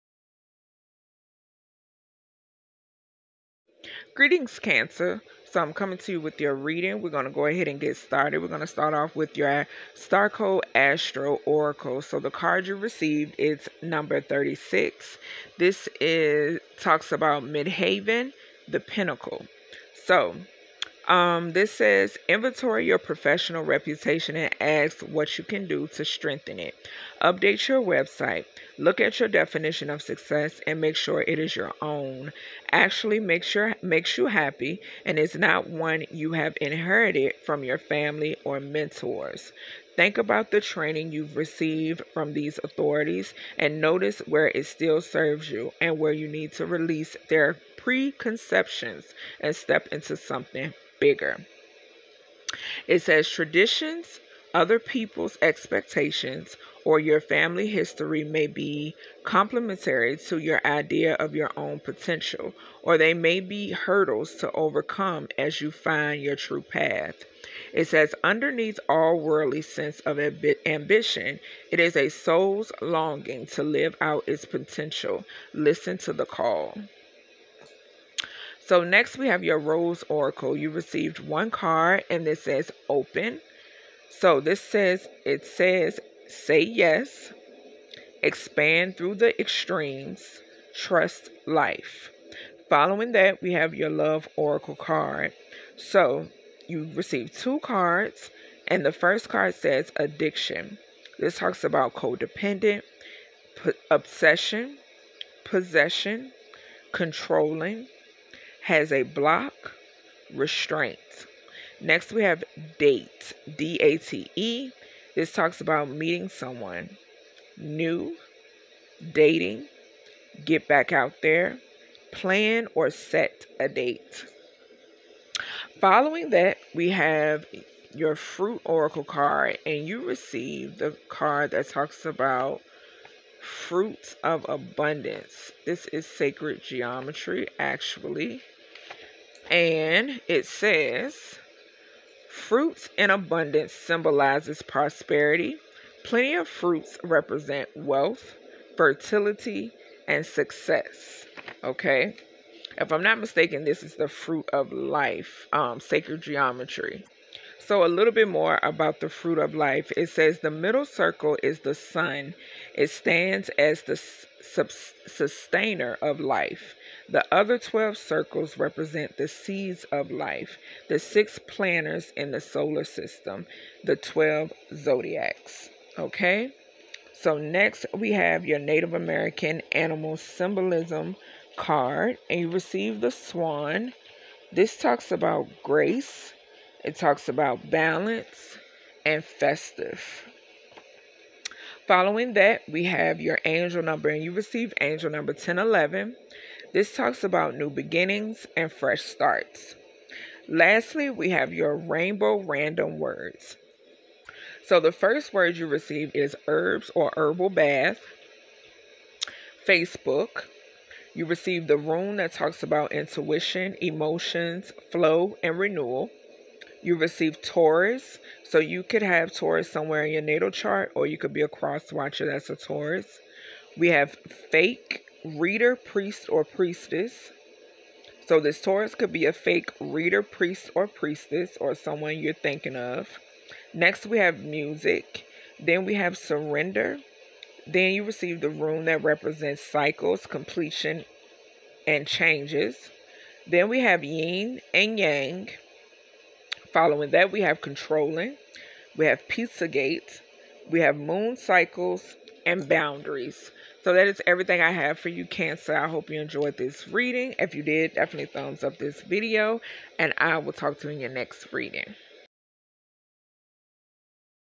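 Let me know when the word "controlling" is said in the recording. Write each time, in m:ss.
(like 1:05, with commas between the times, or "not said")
1:46, 4:07.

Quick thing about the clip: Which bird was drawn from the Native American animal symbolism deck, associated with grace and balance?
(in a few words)
Swan.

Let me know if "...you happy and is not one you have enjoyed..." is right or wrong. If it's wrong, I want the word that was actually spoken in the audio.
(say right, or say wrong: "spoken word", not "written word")
wrong: "inherited", not "enjoyed".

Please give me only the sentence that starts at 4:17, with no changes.
If you did, definitely thumbs up this video, and I will talk to you in your next reading.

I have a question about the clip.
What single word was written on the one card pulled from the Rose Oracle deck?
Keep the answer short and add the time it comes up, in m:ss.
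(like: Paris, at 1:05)
Open, at 1:22.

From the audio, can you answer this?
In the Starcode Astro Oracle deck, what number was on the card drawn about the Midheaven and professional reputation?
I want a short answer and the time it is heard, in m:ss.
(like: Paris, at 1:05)
36, at 0:13.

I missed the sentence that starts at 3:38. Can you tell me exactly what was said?
So you could have Taurus somewhere in your natal chart, or you could be a cross watcher that's a Taurus.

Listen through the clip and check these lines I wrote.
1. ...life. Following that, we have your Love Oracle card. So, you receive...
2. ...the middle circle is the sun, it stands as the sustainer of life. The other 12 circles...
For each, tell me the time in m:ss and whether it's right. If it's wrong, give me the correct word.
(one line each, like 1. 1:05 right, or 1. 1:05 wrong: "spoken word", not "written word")
1. 1:31 right
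2. 2:40 right.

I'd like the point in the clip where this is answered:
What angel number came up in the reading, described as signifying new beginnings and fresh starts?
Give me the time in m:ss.
3:14.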